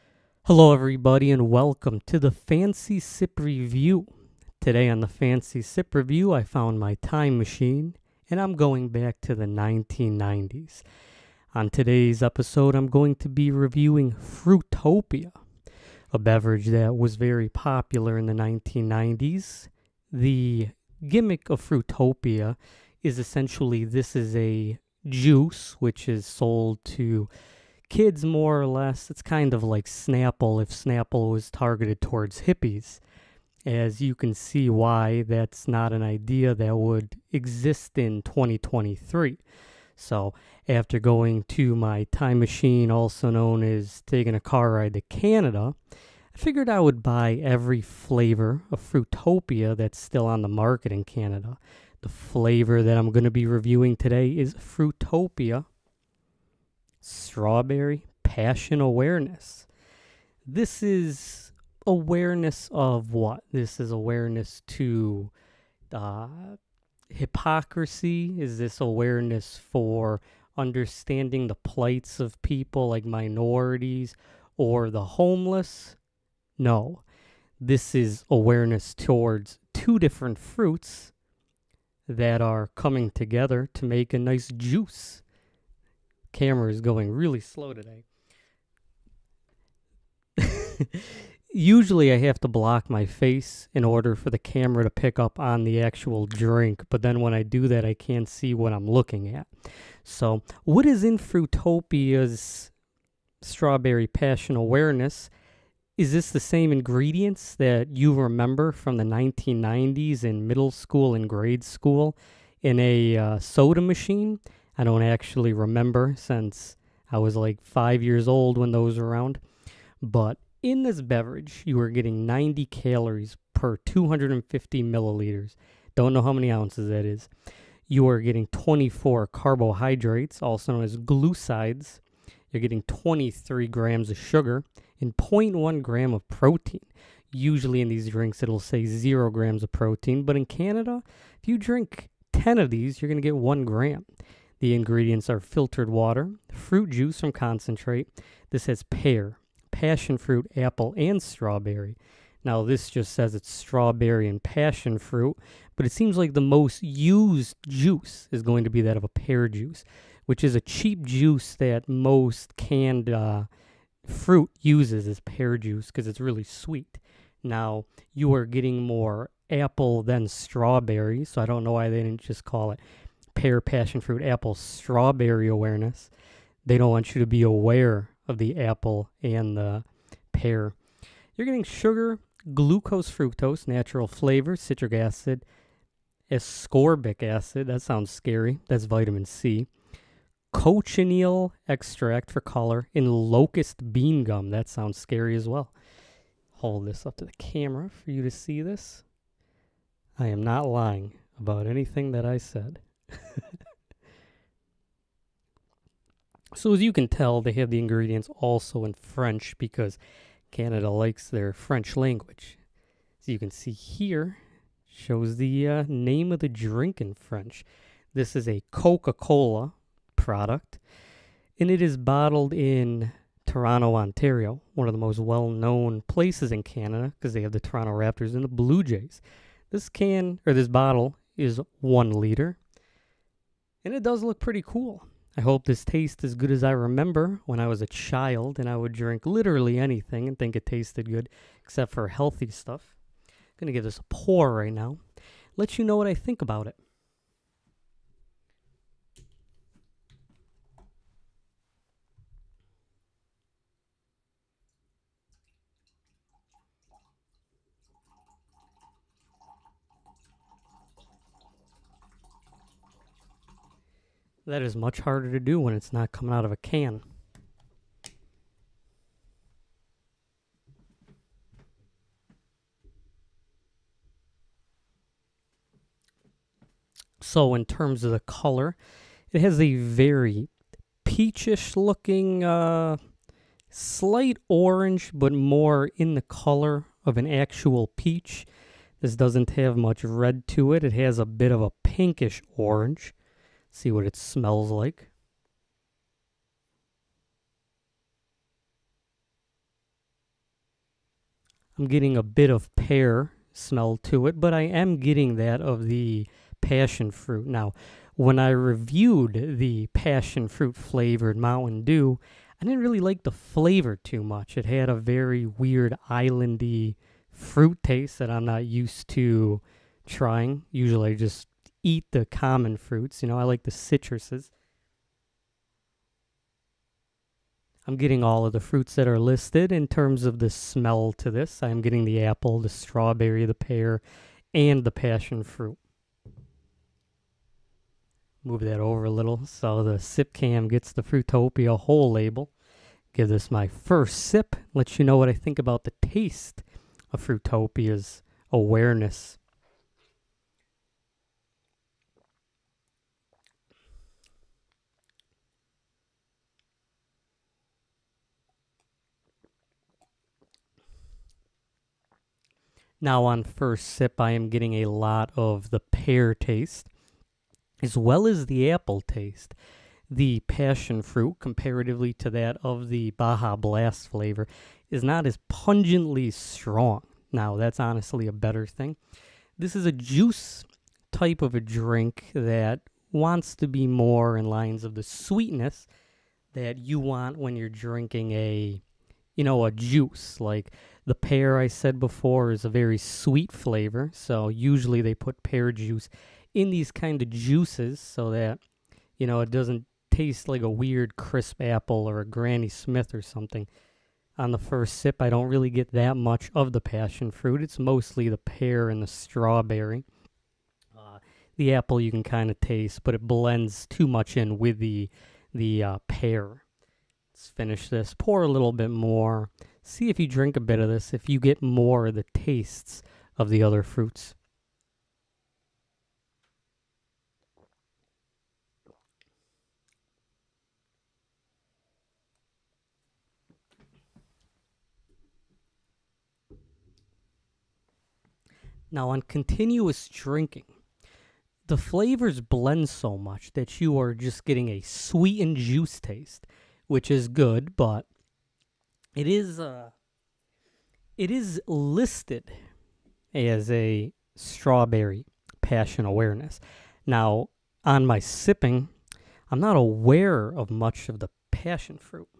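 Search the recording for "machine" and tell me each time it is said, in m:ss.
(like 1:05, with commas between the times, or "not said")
0:07, 0:42, 1:53.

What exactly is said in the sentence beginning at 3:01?
You're getting sugar, glucose, fructose, natural flavor, citric acid, ascorbic acid.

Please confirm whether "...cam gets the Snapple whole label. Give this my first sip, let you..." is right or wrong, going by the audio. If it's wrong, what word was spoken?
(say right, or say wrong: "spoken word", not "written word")
wrong: "Fruitopia", not "Snapple".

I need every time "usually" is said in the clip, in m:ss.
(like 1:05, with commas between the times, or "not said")
1:31, 2:17, 5:20, 6:34.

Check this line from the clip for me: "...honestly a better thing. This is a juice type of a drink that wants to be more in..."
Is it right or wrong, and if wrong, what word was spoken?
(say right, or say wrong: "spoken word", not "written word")
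right.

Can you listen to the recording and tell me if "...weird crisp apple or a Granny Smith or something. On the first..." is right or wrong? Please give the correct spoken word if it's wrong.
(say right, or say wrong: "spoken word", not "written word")
right.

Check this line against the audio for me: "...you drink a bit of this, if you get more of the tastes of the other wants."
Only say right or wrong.
wrong.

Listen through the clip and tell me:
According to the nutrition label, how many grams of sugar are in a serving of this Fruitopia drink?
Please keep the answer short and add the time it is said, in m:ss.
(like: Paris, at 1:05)
23 grams, at 2:12.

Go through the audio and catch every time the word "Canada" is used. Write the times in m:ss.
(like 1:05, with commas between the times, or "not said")
0:45, 0:51, 2:20, 3:30, 3:46.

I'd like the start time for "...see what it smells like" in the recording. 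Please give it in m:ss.
4:53.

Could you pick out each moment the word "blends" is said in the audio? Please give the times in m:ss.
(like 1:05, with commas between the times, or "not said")
6:53, 7:22.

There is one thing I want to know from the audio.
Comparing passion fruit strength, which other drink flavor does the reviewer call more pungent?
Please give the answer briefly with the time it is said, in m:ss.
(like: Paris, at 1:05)
Baja Blast, at 6:13.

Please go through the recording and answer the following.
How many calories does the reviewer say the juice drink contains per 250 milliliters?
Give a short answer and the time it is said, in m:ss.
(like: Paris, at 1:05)
90, at 2:02.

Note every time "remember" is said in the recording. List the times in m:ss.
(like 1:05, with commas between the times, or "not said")
1:48, 1:55, 3:56.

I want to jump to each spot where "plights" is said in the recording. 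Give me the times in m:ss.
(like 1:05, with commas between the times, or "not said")
1:11.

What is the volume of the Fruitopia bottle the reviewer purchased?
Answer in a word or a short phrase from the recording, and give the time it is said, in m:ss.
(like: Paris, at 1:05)
1 liter, at 3:51.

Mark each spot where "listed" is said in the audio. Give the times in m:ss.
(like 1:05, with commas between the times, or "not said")
5:29, 7:31.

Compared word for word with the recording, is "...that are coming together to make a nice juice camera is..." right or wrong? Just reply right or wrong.
right.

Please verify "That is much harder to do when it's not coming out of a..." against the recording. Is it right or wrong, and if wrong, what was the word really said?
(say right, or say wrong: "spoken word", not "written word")
right.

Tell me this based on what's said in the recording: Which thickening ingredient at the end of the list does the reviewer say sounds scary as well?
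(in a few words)
locust bean gum.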